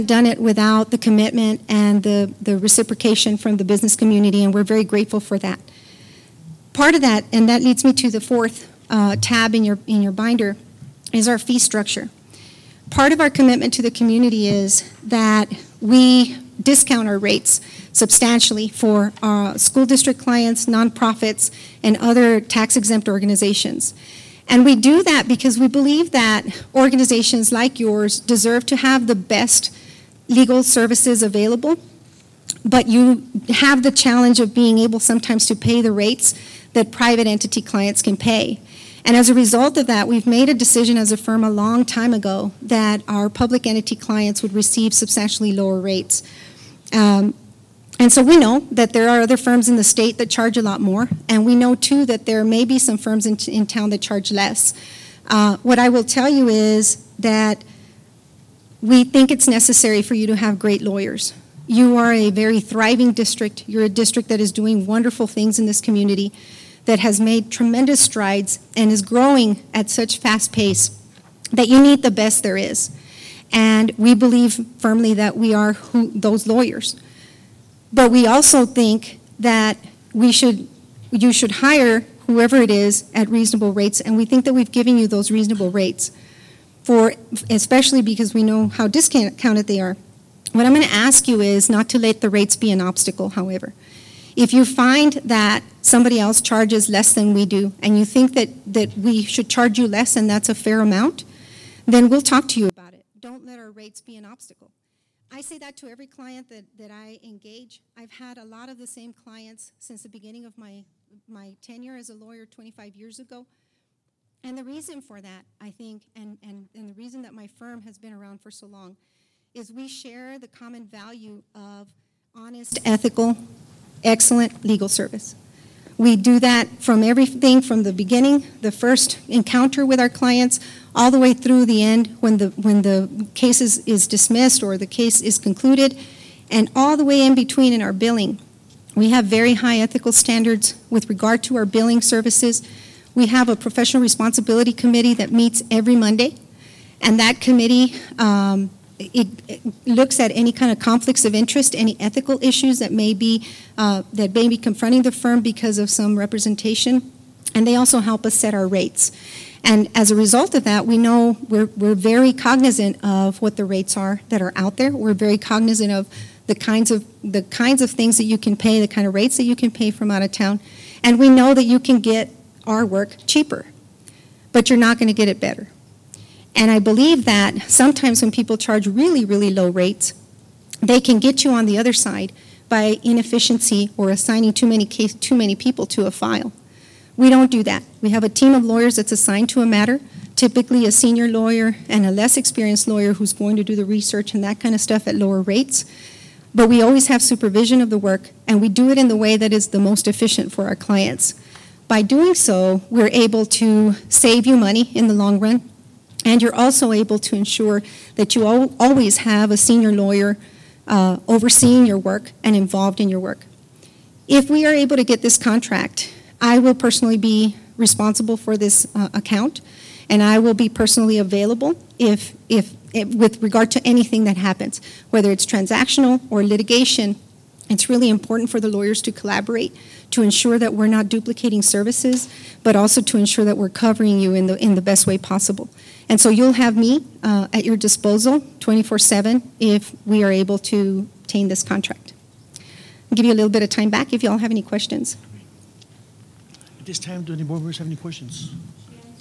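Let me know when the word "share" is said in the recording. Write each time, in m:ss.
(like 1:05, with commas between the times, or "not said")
1:59.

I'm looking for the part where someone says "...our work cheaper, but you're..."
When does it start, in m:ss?
2:52.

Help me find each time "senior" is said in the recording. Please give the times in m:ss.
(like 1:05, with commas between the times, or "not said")
3:10, 3:29.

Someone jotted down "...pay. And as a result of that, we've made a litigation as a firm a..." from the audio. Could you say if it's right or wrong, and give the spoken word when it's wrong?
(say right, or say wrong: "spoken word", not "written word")
wrong: "decision", not "litigation".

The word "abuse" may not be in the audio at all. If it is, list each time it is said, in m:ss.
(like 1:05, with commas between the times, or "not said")
not said.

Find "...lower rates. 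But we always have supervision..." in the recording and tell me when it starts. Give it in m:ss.
3:15.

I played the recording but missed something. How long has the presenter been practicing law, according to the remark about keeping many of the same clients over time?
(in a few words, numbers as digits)
25 years.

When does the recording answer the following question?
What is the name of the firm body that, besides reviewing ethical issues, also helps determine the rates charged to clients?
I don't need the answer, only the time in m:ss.
2:23.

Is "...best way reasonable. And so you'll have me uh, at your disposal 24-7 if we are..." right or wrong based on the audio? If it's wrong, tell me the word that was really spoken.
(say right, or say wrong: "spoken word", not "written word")
wrong: "possible", not "reasonable".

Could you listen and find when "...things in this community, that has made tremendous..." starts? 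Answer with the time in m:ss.
1:05.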